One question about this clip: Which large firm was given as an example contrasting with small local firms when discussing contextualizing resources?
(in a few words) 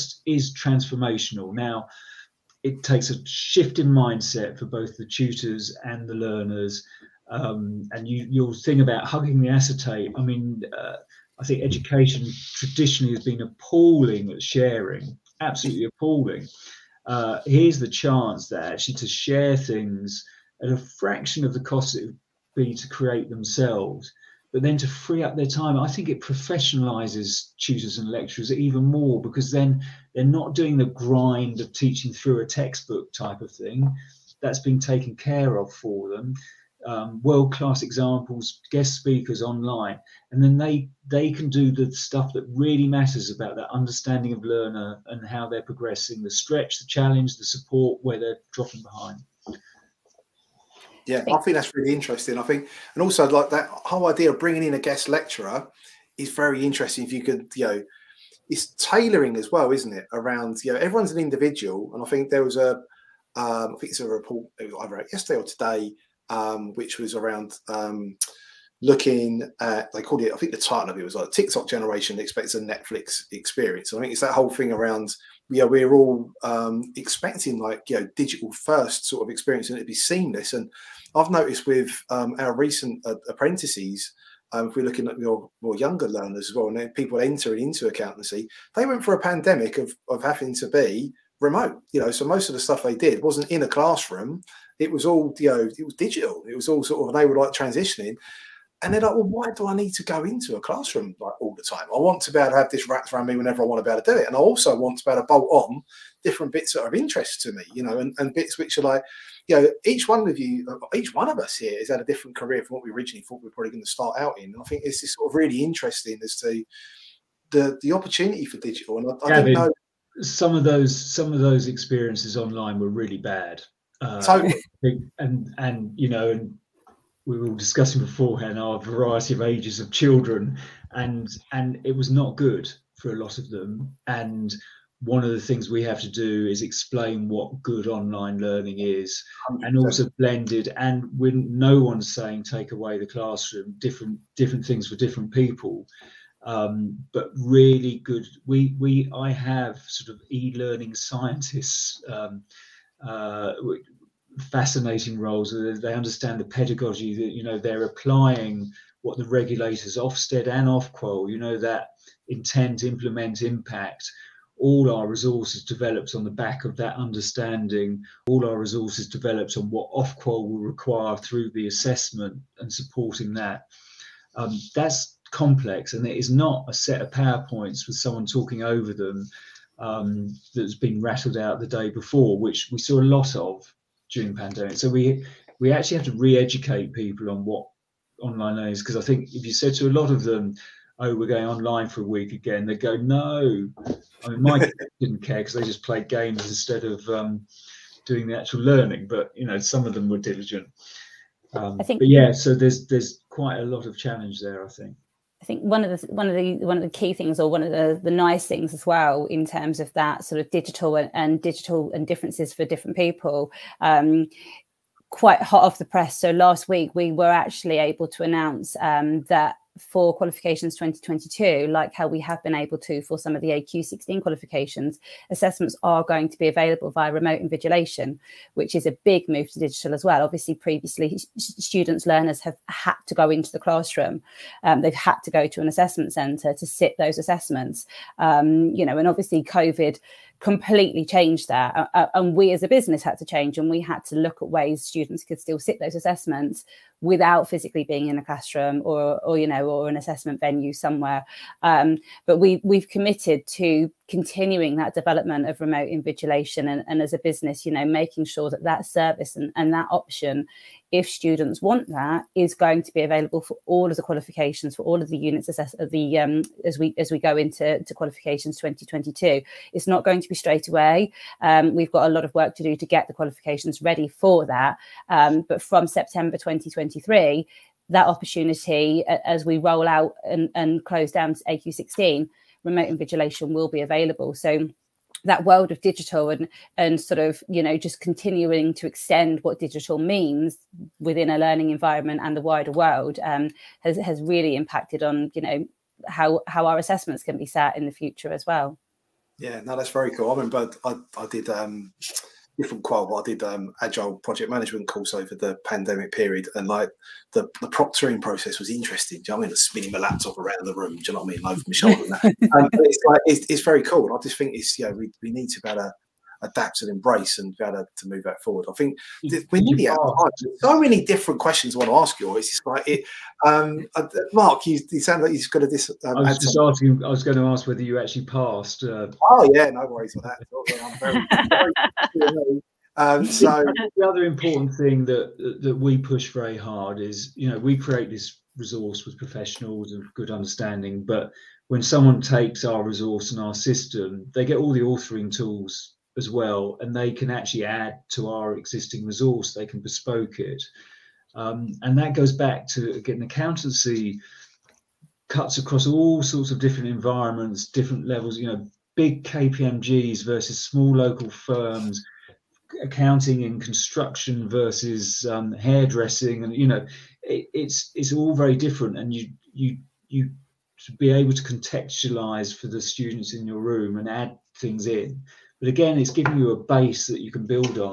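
KPMG.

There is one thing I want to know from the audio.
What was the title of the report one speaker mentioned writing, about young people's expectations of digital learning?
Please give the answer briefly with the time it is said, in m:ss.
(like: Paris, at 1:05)
TikTok generation expects a Netflix experience, at 1:11.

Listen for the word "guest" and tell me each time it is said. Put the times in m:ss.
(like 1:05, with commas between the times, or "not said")
0:38, 0:54.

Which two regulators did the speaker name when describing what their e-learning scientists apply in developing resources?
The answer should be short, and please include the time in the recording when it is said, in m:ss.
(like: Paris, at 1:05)
Ofsted and Ofqual, at 2:39.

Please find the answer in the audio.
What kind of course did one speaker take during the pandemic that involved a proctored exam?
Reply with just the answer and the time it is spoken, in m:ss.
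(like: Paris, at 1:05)
Agile project management, at 5:03.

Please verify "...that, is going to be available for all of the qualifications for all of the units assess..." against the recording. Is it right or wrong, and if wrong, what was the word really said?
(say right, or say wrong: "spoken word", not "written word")
right.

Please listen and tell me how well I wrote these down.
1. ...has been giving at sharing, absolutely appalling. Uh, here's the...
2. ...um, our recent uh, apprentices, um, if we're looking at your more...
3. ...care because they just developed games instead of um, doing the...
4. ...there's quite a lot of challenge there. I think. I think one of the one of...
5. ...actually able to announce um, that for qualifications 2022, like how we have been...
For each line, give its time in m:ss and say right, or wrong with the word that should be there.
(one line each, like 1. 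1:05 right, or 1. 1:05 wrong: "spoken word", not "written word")
1. 0:13 wrong: "appalling", not "giving"
2. 1:22 right
3. 3:15 wrong: "played", not "developed"
4. 3:22 right
5. 3:37 right.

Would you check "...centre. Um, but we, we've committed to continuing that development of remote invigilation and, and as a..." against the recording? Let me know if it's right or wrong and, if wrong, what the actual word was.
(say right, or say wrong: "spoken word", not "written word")
wrong: "somewhere", not "centre".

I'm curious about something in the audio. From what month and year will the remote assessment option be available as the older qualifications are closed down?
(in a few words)
September 2023.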